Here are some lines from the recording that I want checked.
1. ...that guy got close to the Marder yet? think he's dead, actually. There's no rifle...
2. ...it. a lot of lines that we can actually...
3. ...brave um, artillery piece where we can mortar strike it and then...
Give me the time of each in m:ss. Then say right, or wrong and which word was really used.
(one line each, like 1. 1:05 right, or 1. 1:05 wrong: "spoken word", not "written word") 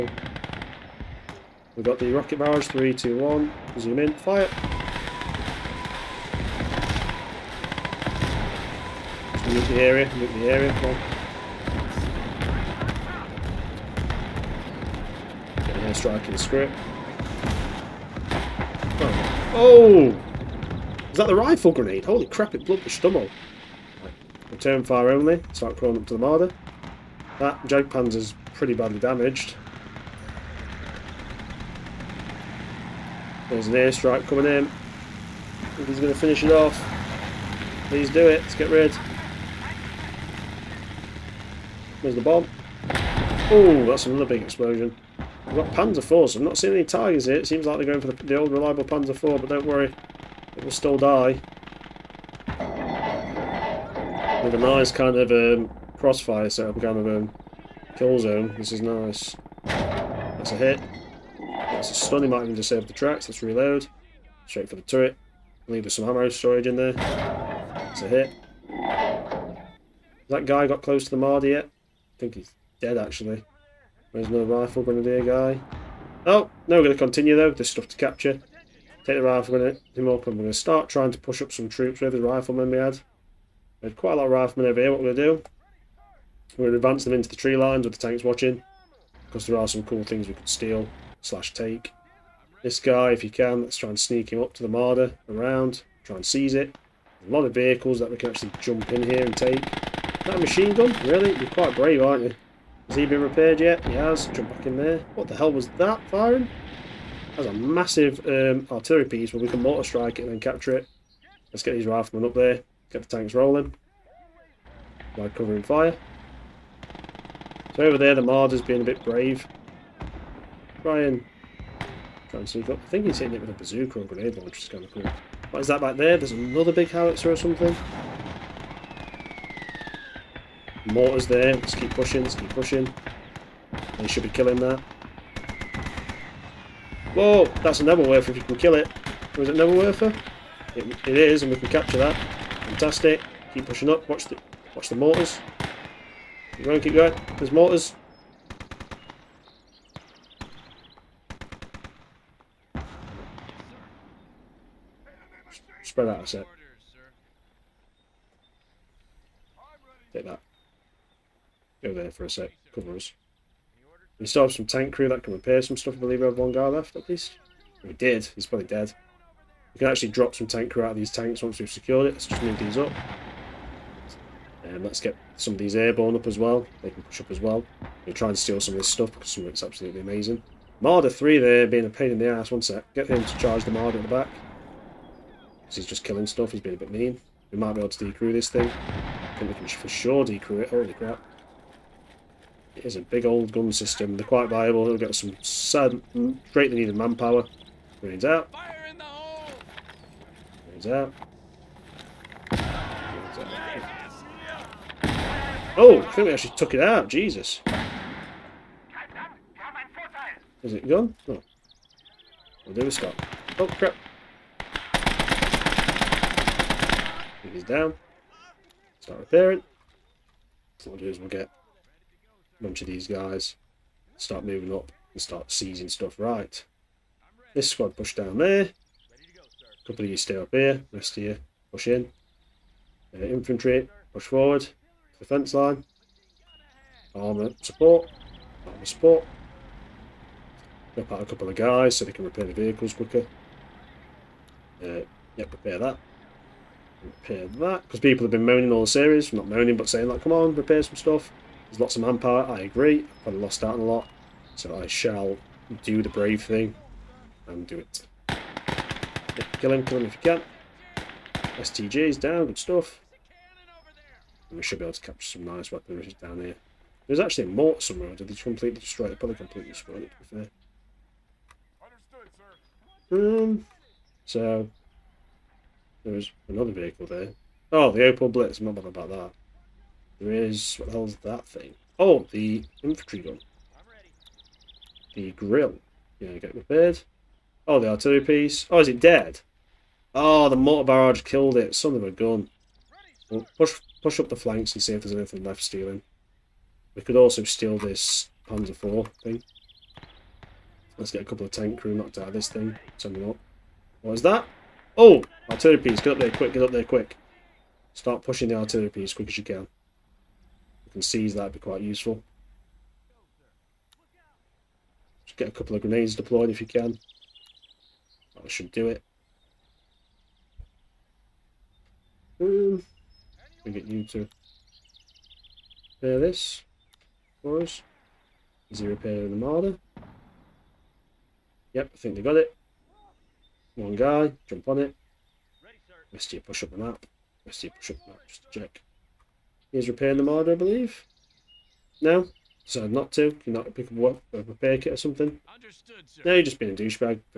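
1. 1:10 right
2. 1:36 wrong: "vehicles", not "lines"
3. 1:47 wrong: "massive", not "brave".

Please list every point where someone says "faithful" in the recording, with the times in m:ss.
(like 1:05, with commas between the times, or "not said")
not said.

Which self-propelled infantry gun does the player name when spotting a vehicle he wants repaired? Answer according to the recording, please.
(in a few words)
Grille.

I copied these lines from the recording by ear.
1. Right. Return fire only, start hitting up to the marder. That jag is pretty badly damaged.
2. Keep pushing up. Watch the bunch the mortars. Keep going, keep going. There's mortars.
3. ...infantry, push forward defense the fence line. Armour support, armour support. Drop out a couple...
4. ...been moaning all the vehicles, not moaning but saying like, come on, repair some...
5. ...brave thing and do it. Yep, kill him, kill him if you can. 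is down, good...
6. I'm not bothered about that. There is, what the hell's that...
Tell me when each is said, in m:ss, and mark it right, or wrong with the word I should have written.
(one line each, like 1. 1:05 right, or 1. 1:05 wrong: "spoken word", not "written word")
1. 0:24 wrong: "crawling", not "hitting"
2. 2:23 wrong: "watch", not "bunch"
3. 3:53 right
4. 4:08 wrong: "series", not "vehicles"
5. 4:16 right
6. 4:38 right.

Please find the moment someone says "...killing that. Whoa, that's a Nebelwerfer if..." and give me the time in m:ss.
2:14.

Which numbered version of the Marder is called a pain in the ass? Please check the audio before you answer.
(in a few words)
3.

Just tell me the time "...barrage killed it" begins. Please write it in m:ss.
4:50.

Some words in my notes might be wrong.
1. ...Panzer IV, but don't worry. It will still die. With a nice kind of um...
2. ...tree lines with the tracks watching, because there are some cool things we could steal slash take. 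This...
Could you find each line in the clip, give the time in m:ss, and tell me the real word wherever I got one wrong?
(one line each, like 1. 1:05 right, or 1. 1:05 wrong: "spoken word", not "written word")
1. 0:48 right
2. 1:27 wrong: "tanks", not "tracks".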